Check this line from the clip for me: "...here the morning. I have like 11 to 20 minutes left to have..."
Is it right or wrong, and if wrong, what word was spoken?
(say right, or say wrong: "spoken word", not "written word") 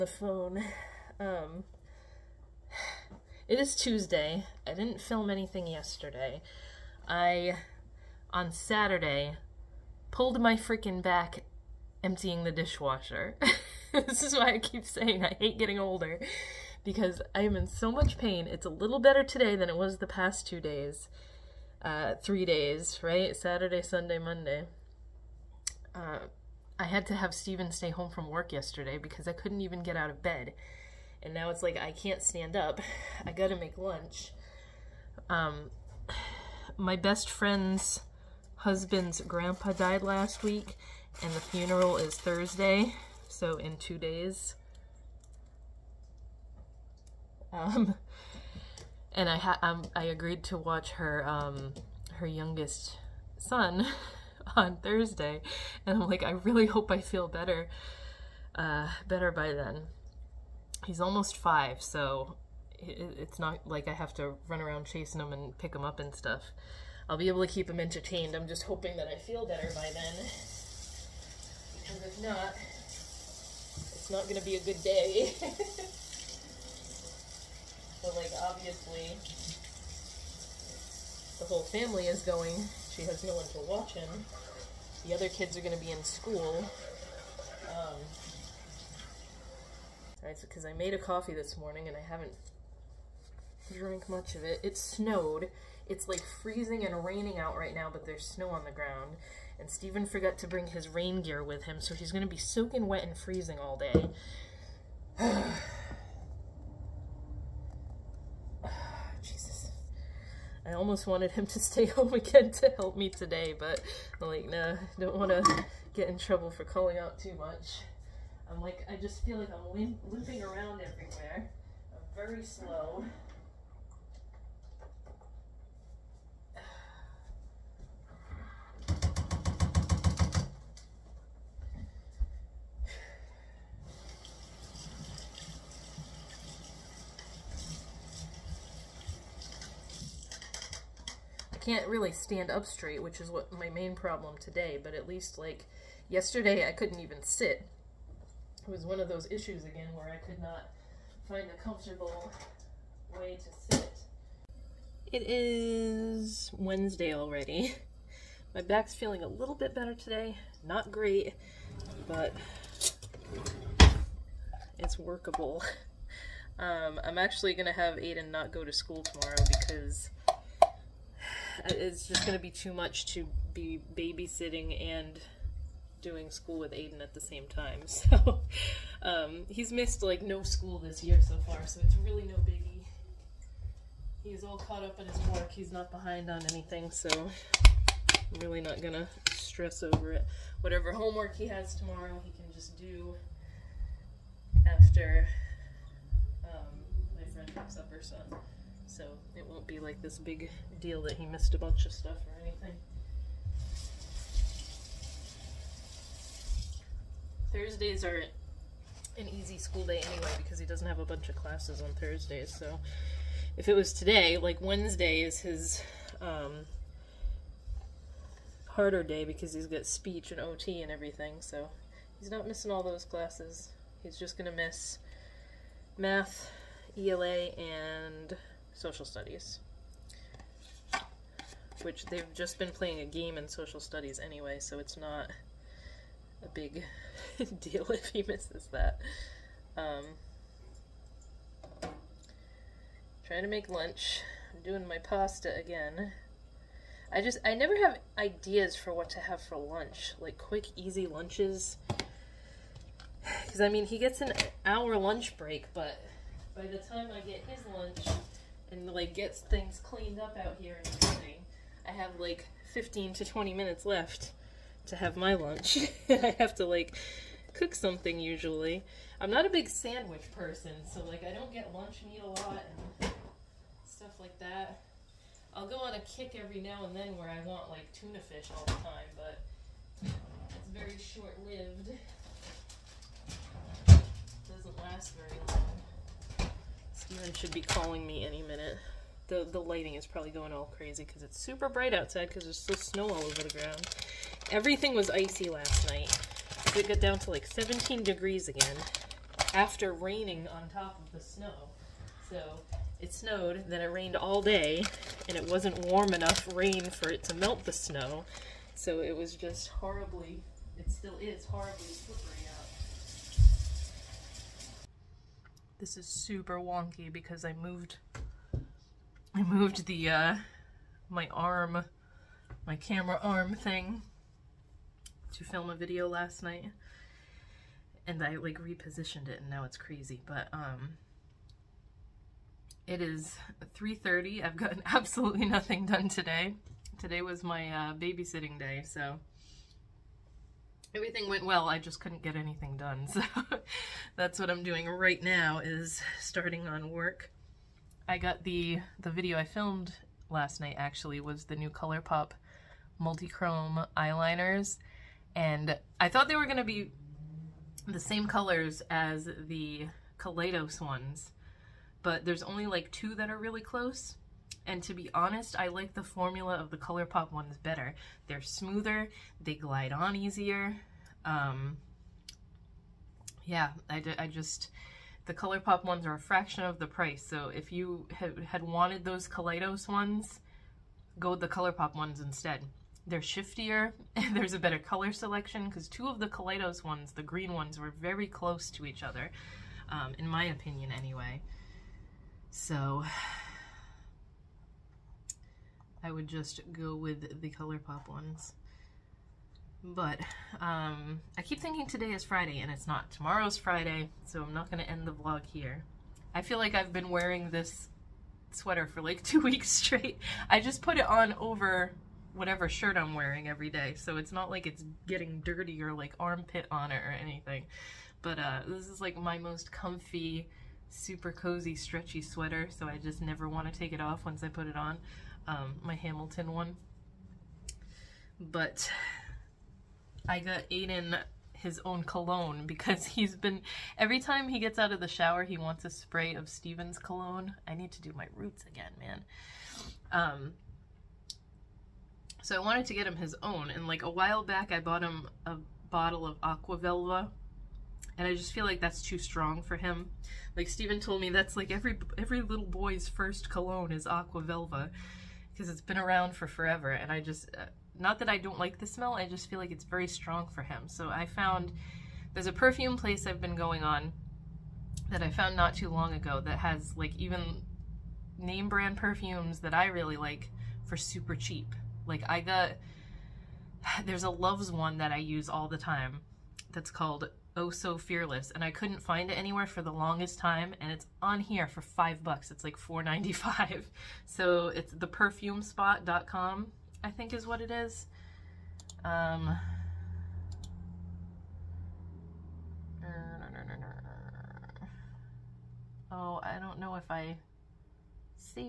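wrong: "15", not "11".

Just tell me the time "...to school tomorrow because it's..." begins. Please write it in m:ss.
2:48.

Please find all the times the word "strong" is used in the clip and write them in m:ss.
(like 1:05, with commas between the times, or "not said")
7:29, 7:40.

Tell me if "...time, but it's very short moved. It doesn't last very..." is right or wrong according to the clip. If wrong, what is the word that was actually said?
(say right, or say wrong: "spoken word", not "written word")
wrong: "lived", not "moved".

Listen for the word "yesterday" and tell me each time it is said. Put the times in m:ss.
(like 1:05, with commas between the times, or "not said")
0:05, 0:28, 2:26.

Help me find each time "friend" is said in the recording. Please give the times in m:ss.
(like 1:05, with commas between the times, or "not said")
0:37, 3:17.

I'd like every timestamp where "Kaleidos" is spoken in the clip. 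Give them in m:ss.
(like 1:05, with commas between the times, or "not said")
6:00, 6:19, 6:26.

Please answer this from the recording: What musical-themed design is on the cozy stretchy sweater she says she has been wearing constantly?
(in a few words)
Hamilton.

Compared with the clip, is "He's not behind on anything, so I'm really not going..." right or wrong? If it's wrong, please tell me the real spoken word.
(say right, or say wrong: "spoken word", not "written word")
right.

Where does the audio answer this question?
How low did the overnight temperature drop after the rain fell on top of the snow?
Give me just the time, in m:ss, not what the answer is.
4:57.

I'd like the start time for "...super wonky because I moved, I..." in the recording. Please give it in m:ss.
5:16.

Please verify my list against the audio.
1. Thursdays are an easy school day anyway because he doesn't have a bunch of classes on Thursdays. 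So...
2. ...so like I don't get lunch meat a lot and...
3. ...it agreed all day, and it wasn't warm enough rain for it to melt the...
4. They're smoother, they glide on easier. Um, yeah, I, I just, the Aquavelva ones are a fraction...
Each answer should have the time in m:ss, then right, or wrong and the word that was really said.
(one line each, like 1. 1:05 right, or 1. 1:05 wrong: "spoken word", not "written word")
1. 3:27 right
2. 4:30 right
3. 5:03 wrong: "rained", not "agreed"
4. 6:08 wrong: "ColourPop", not "Aquavelva".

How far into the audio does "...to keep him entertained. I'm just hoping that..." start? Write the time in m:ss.
1:07.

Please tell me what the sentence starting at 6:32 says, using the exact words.
So, I would just go with the ColourPop ones.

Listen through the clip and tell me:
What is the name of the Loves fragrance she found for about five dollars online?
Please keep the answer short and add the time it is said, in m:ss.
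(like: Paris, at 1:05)
Oh So Fearless, at 7:57.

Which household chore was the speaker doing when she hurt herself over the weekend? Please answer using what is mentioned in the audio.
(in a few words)
Emptying the dishwasher.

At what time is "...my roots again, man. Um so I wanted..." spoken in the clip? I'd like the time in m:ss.
7:18.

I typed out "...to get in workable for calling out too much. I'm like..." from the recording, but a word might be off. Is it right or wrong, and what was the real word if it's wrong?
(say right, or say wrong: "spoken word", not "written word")
wrong: "trouble", not "workable".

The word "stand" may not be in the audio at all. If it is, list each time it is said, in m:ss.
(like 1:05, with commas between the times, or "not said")
0:32, 2:22.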